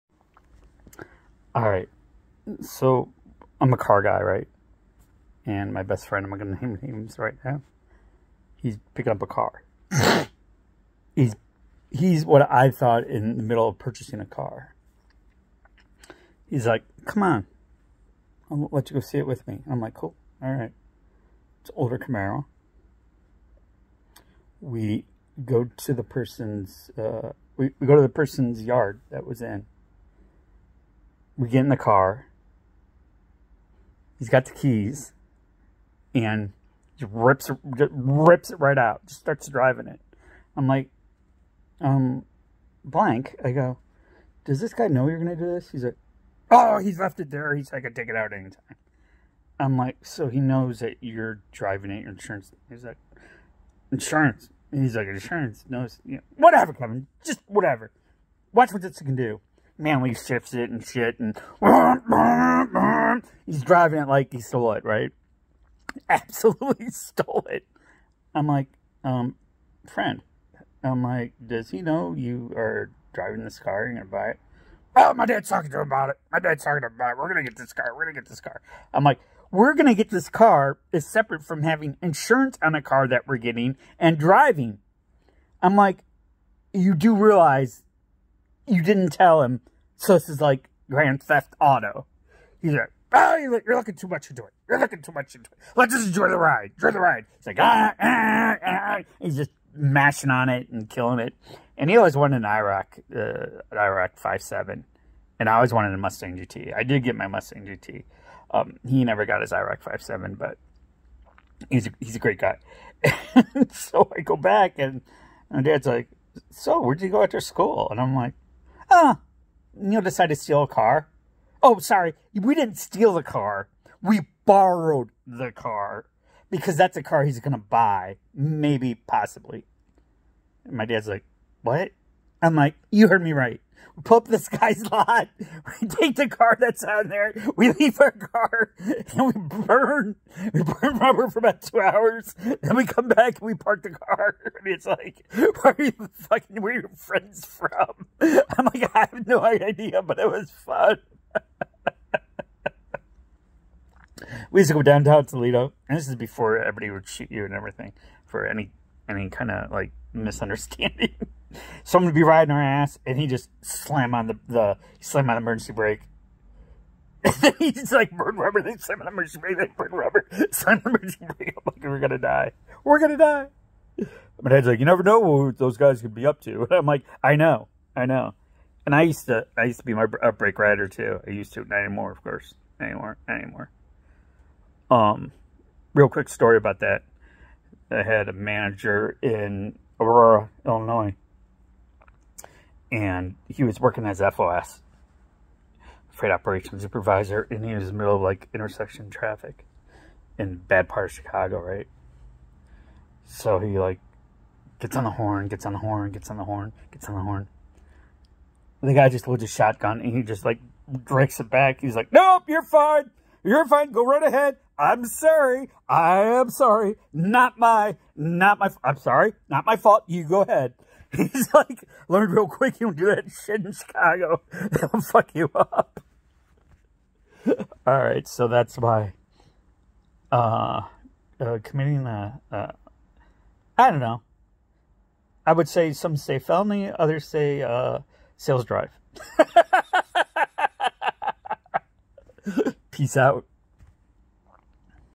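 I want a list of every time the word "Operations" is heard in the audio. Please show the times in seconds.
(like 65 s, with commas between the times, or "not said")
196 s.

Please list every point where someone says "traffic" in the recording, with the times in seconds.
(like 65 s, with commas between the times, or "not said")
199 s.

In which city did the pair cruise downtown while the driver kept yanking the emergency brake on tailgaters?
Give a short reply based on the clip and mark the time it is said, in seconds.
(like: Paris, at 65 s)
Toledo, at 155 s.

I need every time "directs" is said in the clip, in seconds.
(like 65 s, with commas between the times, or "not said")
211 s.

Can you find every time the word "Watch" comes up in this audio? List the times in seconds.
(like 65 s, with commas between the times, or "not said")
58 s.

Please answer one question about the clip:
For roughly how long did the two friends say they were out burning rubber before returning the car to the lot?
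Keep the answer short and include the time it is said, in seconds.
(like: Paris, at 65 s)
2 hours, at 141 s.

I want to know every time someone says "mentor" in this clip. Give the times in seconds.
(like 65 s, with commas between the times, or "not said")
not said.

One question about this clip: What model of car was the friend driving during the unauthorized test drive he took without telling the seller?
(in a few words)
Camaro.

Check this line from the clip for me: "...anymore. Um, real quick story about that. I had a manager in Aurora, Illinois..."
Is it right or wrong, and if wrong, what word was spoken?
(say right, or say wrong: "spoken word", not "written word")
right.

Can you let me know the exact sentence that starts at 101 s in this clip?
And he always wanted an IROC, uh, an IROC 5.7.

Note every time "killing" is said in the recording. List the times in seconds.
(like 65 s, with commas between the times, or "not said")
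100 s.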